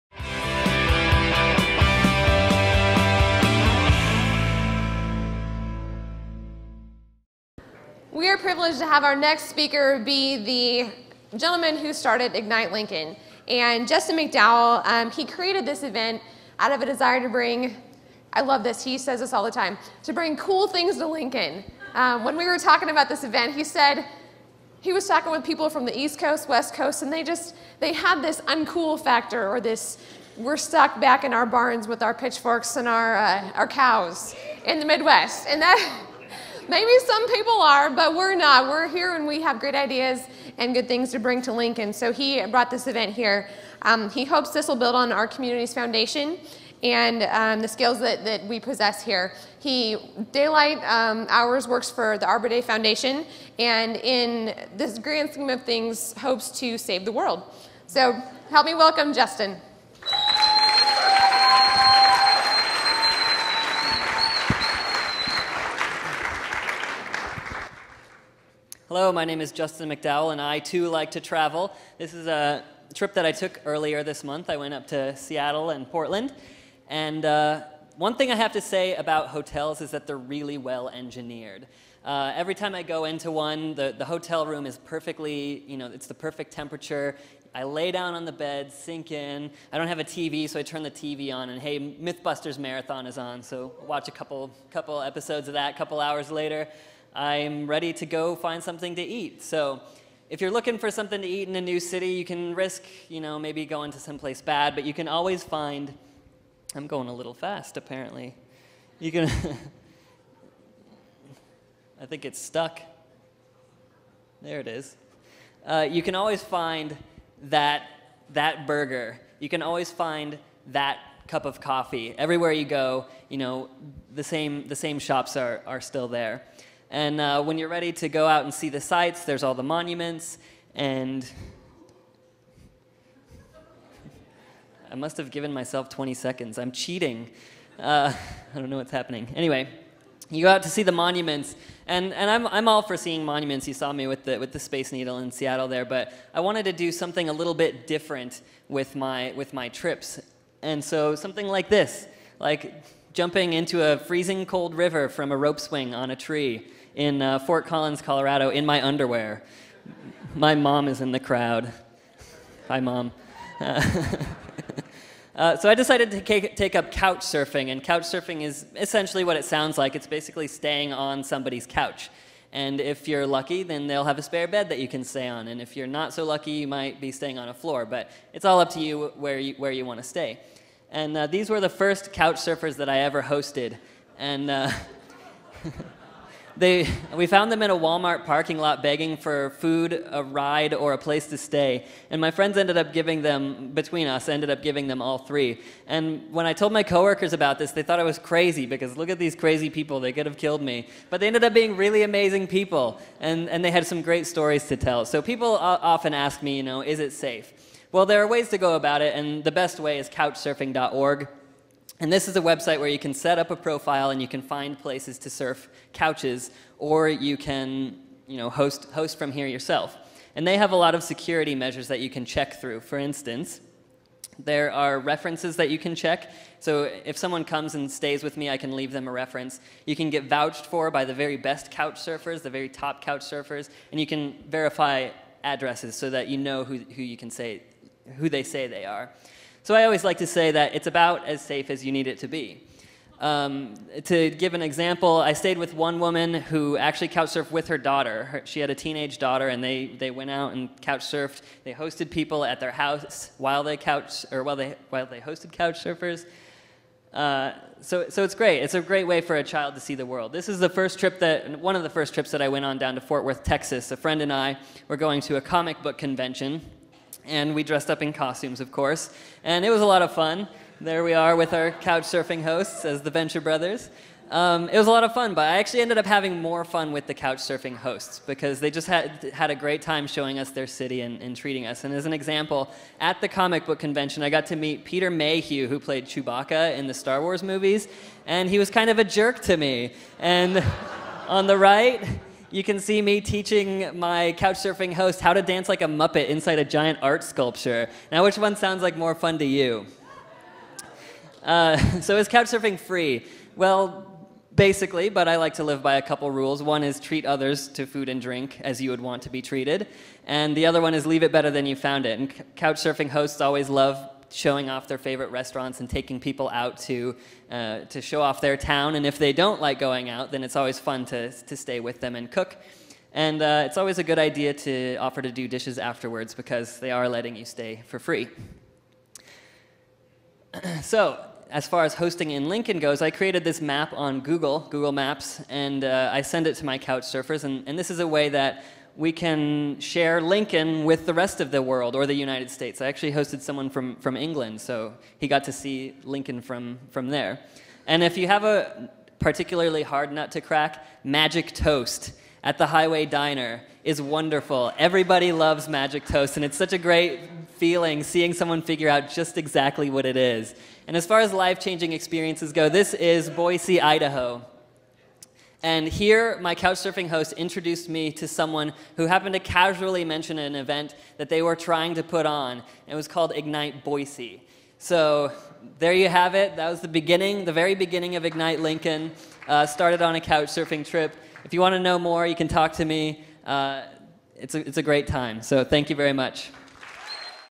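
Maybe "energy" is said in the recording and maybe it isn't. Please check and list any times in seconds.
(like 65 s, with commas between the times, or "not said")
not said.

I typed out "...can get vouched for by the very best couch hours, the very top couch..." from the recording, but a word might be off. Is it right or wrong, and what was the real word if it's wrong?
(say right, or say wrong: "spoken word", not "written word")
wrong: "surfers", not "hours".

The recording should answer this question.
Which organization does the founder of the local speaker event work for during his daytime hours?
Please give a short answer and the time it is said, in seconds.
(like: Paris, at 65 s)
Arbor Day Foundation, at 52 s.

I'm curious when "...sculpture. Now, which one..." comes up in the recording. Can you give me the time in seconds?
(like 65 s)
297 s.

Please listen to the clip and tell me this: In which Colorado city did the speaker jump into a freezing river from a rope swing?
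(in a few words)
Fort Collins.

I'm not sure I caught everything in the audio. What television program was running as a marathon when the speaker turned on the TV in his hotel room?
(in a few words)
Mythbusters.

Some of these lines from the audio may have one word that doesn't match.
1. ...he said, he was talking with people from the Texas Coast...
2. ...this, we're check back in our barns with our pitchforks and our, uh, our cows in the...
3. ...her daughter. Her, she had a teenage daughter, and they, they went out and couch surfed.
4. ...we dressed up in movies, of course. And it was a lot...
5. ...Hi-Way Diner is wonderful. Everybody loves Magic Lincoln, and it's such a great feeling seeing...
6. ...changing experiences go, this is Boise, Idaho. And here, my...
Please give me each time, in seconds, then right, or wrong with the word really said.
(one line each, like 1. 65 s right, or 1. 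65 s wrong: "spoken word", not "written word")
1. 23 s wrong: "East", not "Texas"
2. 29 s wrong: "stuck", not "check"
3. 247 s right
4. 267 s wrong: "costumes", not "movies"
5. 352 s wrong: "Toast", not "Lincoln"
6. 361 s right.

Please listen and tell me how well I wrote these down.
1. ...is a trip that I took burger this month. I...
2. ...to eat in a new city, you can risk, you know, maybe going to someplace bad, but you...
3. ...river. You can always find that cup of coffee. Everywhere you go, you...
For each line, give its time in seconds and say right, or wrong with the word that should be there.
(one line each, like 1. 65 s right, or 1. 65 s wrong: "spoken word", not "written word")
1. 72 s wrong: "earlier", not "burger"
2. 101 s right
3. 118 s wrong: "burger", not "river".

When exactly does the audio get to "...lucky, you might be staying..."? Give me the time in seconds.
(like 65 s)
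176 s.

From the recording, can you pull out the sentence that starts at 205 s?
So people often ask me, you know, is it safe?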